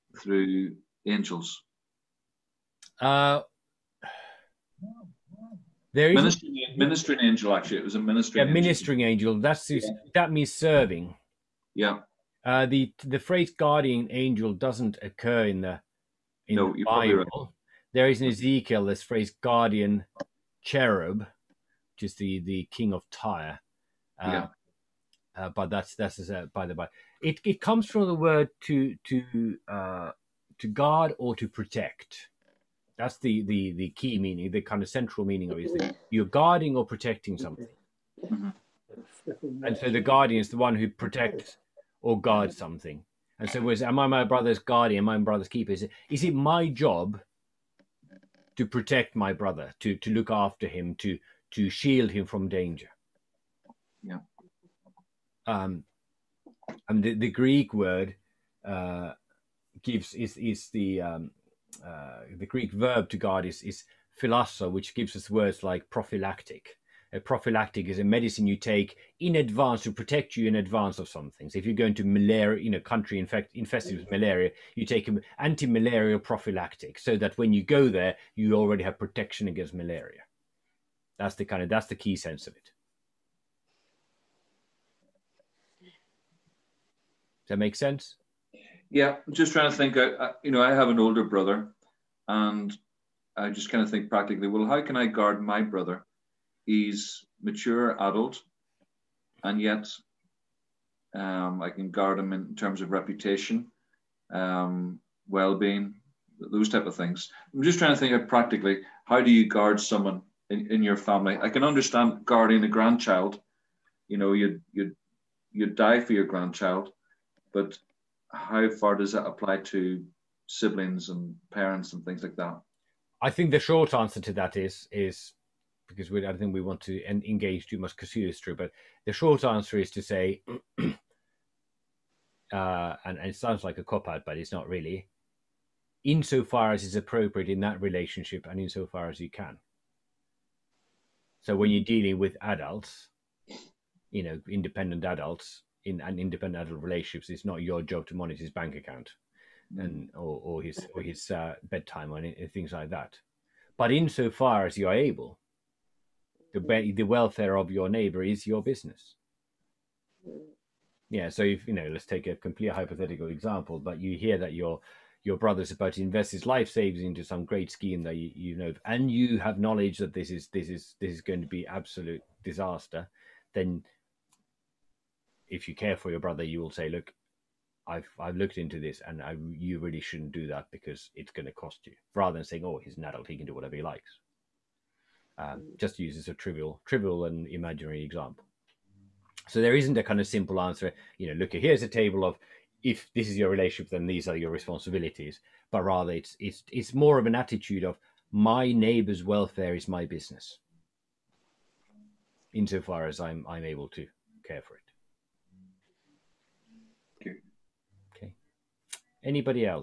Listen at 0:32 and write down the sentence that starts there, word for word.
That's the the the key meaning, the kind of central meaning of it.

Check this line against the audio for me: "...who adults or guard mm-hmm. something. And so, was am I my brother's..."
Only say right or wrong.
wrong.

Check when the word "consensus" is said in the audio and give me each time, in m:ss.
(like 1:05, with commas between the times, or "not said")
not said.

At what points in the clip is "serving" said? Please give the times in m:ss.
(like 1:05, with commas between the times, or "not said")
0:10.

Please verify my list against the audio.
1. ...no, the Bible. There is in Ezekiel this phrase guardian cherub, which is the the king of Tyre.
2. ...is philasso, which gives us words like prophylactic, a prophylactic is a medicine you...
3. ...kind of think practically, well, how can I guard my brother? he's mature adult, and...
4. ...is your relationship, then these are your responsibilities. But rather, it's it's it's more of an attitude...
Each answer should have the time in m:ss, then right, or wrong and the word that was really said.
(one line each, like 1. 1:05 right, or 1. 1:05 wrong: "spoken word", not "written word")
1. 0:16 right
2. 1:03 right
3. 1:33 right
4. 3:13 right.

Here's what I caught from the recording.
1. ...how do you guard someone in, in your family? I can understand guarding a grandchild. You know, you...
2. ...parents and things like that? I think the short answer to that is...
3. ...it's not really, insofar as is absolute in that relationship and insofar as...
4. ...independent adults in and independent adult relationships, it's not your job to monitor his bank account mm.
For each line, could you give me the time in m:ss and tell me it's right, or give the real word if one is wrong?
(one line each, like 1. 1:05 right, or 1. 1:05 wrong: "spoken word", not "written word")
1. 1:49 right
2. 2:01 right
3. 2:14 wrong: "appropriate", not "absolute"
4. 2:24 right.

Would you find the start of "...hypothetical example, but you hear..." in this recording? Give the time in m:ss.
2:42.